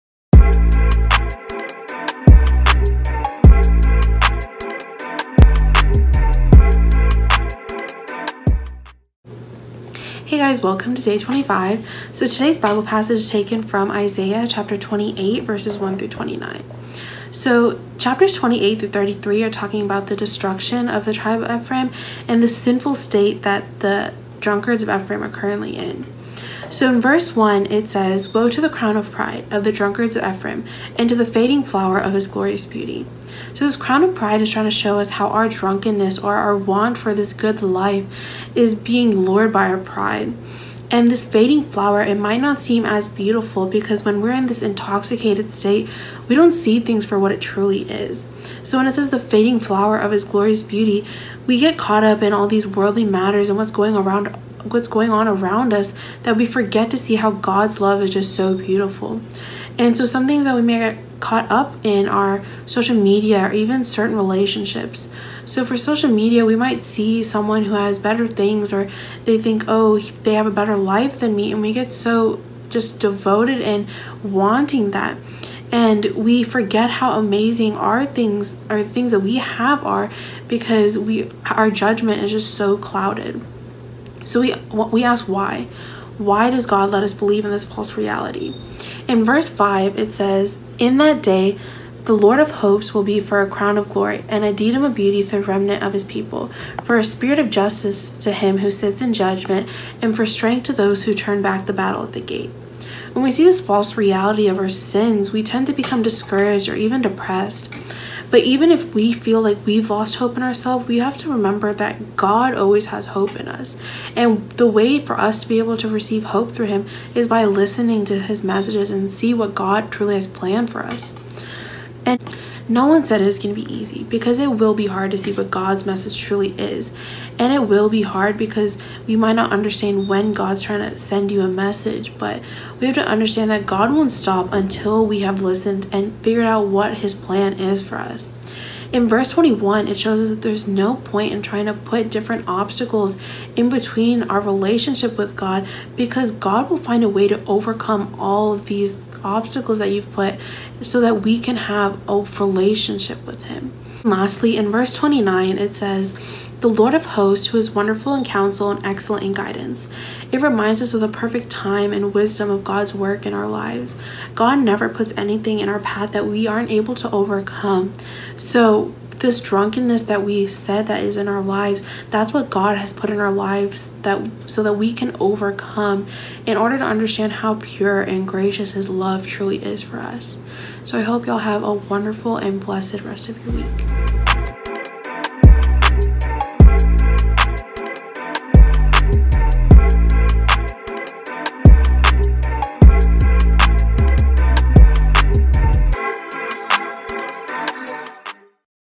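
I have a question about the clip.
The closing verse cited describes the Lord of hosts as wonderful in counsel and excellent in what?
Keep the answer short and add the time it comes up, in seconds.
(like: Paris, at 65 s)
Guidance, at 159 s.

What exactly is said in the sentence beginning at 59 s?
And so some things that we may get caught up in are social media or even certain relationships.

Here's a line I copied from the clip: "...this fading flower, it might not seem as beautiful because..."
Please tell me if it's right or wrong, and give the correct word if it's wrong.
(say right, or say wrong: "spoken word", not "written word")
right.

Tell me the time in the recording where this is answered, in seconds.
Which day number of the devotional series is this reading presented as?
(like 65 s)
11 s.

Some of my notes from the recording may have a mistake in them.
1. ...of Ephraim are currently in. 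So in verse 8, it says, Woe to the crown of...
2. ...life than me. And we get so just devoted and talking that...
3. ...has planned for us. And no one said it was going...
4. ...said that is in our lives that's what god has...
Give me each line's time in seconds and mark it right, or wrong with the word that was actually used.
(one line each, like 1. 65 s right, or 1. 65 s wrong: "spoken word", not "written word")
1. 24 s wrong: "1", not "8"
2. 70 s wrong: "wanting", not "talking"
3. 120 s right
4. 170 s right.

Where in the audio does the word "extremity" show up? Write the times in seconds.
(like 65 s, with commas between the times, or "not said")
not said.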